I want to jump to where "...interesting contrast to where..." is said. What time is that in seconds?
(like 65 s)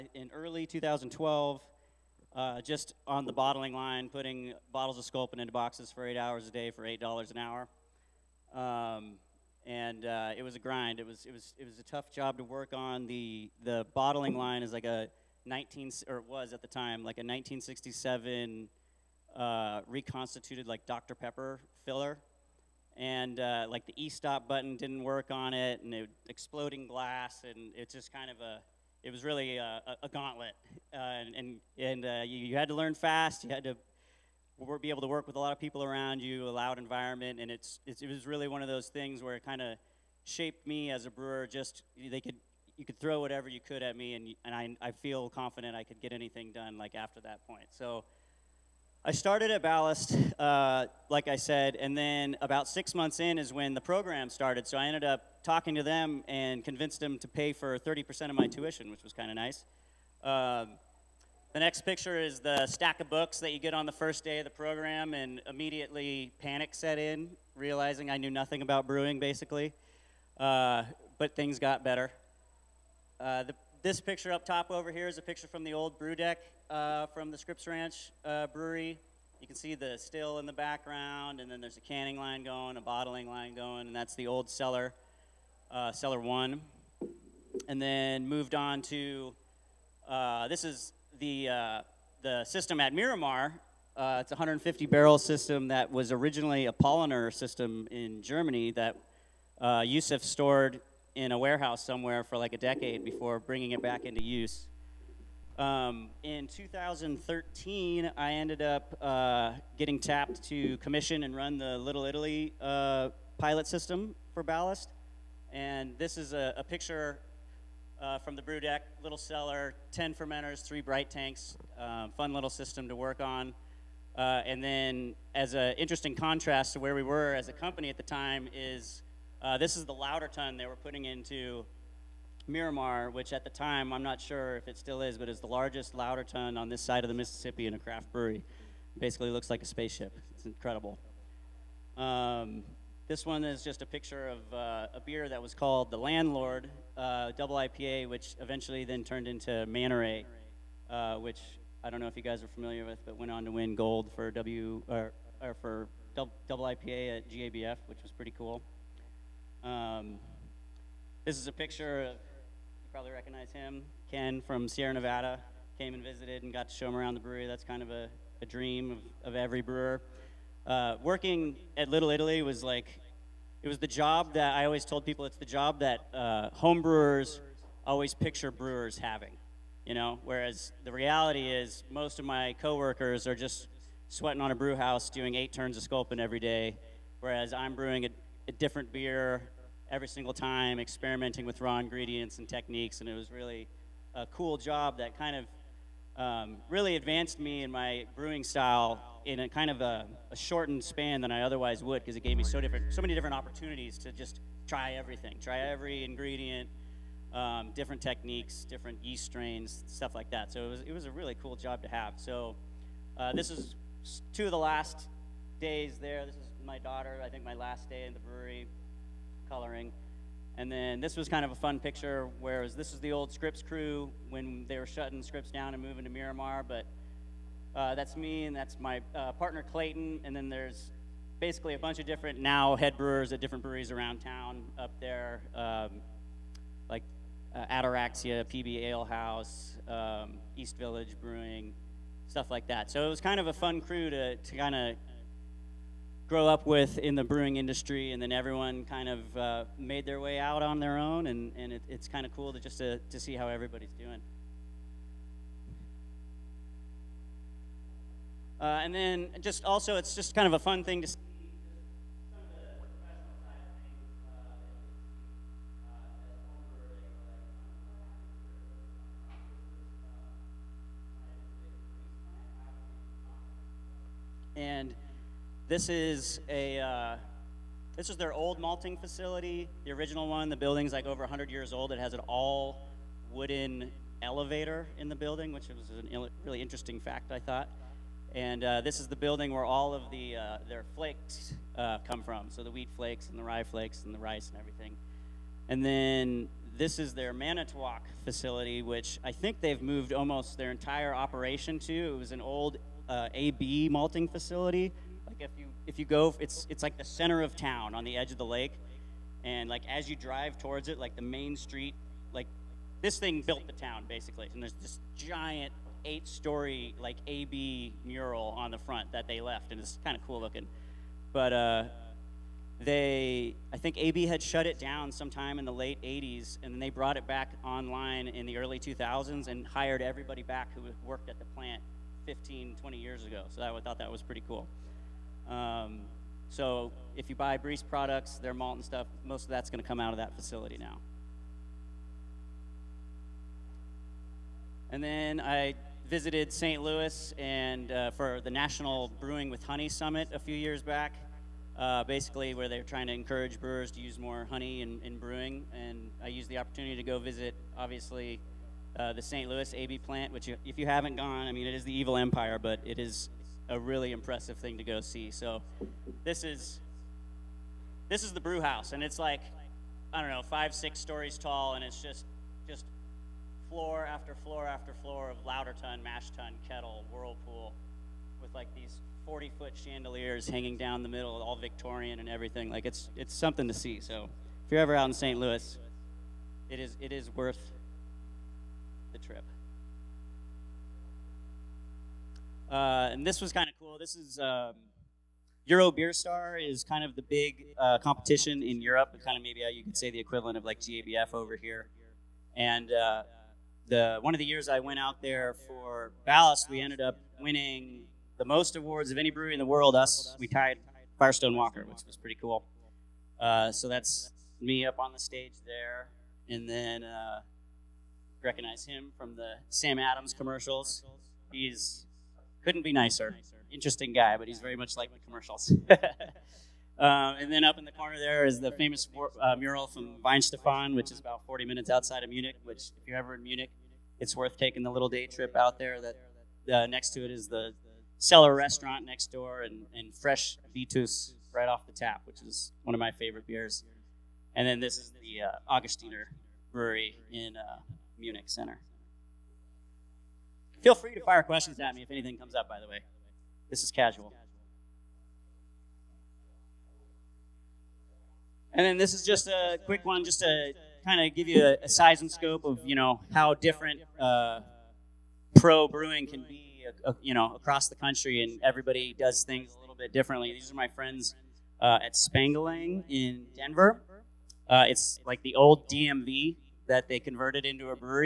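125 s.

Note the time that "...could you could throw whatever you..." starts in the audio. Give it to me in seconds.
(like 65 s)
42 s.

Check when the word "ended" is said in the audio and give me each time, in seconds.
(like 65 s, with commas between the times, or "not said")
54 s, 108 s, 406 s.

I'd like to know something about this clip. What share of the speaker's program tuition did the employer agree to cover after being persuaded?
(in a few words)
30%.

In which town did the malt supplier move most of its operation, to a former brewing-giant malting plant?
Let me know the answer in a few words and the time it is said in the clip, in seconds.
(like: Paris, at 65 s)
Manitowoc, at 297 s.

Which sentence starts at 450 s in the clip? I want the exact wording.
Feel free to fire questions at me if anything comes up, by the way.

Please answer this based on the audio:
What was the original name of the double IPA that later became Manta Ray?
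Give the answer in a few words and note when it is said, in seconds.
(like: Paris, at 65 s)
The Landlord, at 145 s.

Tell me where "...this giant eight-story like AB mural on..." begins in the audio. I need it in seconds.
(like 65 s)
314 s.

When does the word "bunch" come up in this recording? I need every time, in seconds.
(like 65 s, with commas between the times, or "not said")
231 s.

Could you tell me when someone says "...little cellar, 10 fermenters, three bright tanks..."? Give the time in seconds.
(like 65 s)
119 s.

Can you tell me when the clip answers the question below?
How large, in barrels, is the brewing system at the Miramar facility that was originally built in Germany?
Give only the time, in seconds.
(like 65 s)
94 s.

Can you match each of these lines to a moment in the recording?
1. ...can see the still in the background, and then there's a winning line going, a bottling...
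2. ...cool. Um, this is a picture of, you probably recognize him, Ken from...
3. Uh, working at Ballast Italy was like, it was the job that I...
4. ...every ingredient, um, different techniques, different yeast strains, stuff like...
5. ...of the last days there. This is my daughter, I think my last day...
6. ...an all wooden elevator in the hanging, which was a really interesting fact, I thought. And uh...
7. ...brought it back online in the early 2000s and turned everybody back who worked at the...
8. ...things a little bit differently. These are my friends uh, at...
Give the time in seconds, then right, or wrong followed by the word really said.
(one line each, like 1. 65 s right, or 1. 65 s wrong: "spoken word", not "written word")
1. 79 s wrong: "canning", not "winning"
2. 158 s right
3. 170 s wrong: "Little", not "Ballast"
4. 205 s right
5. 214 s right
6. 282 s wrong: "building", not "hanging"
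7. 326 s wrong: "hired", not "turned"
8. 469 s right.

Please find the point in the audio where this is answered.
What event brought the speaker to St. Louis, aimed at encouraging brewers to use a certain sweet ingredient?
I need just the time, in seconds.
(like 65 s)
348 s.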